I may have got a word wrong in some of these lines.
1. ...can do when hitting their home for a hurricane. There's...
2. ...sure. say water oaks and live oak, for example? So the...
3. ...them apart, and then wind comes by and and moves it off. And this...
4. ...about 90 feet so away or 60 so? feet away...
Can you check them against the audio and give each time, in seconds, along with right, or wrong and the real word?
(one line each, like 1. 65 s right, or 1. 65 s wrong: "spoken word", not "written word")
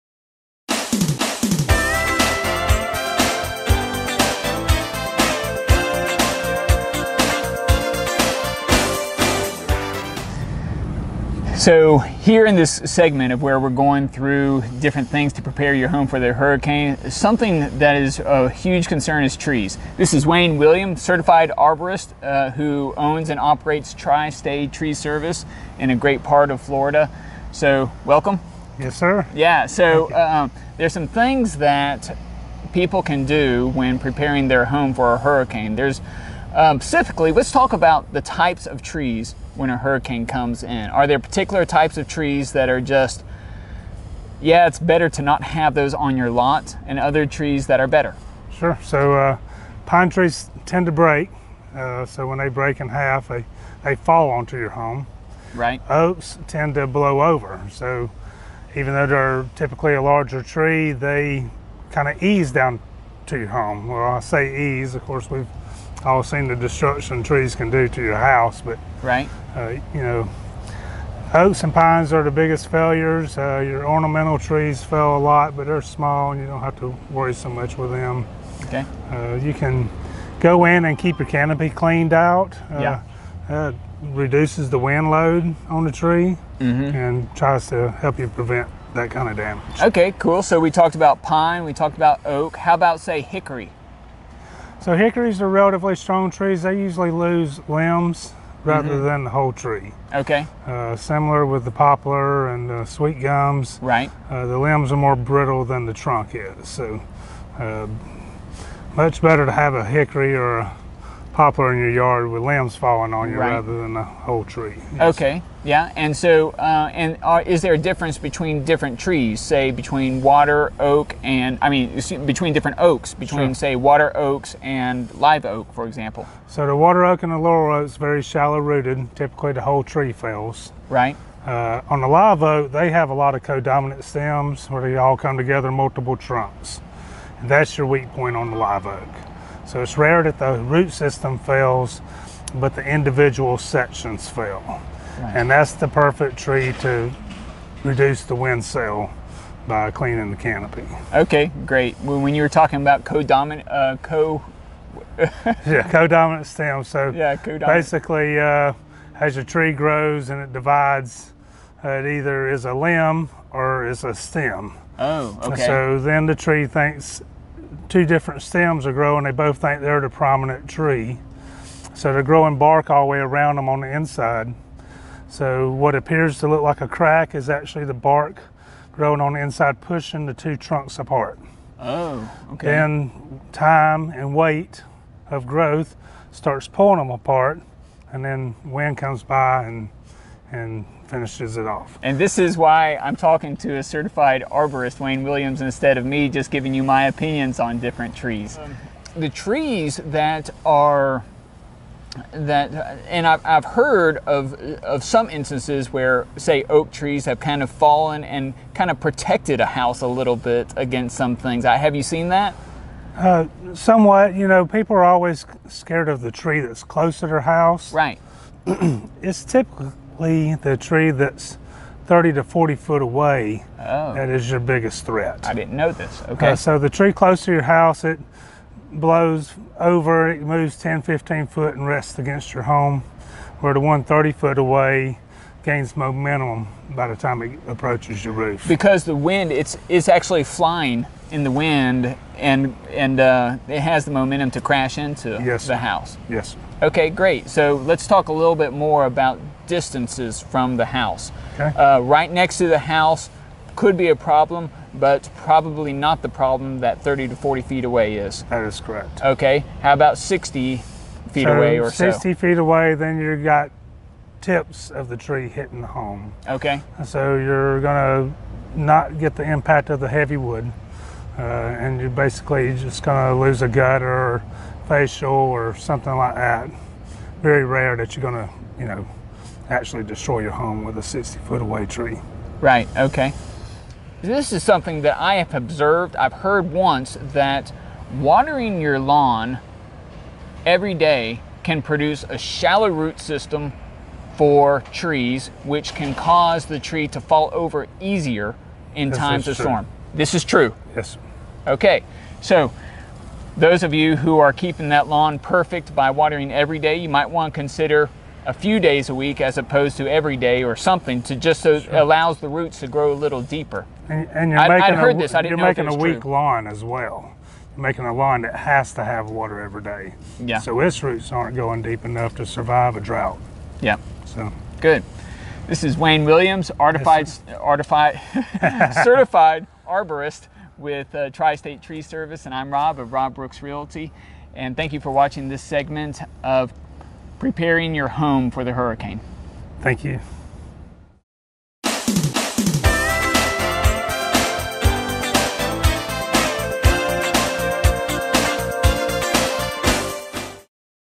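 1. 33 s wrong: "preparing", not "hitting"
2. 123 s right
3. 186 s wrong: "finishes", not "moves"
4. 259 s wrong: "60", not "90".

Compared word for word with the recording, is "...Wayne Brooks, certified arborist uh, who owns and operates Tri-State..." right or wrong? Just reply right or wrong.
wrong.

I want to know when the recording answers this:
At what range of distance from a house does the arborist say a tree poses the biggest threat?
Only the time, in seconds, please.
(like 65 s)
222 s.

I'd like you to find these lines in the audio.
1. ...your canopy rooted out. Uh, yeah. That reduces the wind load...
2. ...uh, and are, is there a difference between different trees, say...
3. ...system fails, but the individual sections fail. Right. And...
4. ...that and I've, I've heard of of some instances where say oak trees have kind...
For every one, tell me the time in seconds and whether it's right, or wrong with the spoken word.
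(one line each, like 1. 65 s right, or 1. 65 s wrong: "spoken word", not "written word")
1. 81 s wrong: "cleaned", not "rooted"
2. 116 s right
3. 140 s right
4. 202 s right.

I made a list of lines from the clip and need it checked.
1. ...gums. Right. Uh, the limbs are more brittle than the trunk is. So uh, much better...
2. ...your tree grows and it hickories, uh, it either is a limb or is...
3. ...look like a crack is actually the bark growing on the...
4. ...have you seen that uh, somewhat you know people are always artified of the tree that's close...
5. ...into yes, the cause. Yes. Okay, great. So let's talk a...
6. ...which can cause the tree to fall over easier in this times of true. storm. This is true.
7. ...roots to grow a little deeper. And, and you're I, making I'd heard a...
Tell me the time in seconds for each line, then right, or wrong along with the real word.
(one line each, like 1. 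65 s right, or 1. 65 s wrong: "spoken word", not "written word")
1. 103 s right
2. 159 s wrong: "divides", not "hickories"
3. 176 s right
4. 211 s wrong: "scared", not "artified"
5. 244 s wrong: "house", not "cause"
6. 295 s right
7. 312 s right.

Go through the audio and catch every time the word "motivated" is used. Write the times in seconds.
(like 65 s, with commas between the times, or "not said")
not said.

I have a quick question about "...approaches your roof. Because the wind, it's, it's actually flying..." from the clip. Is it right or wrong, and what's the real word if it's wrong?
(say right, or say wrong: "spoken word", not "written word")
right.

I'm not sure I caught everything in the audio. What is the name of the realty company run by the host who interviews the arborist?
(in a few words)
Rob Brooks Realty.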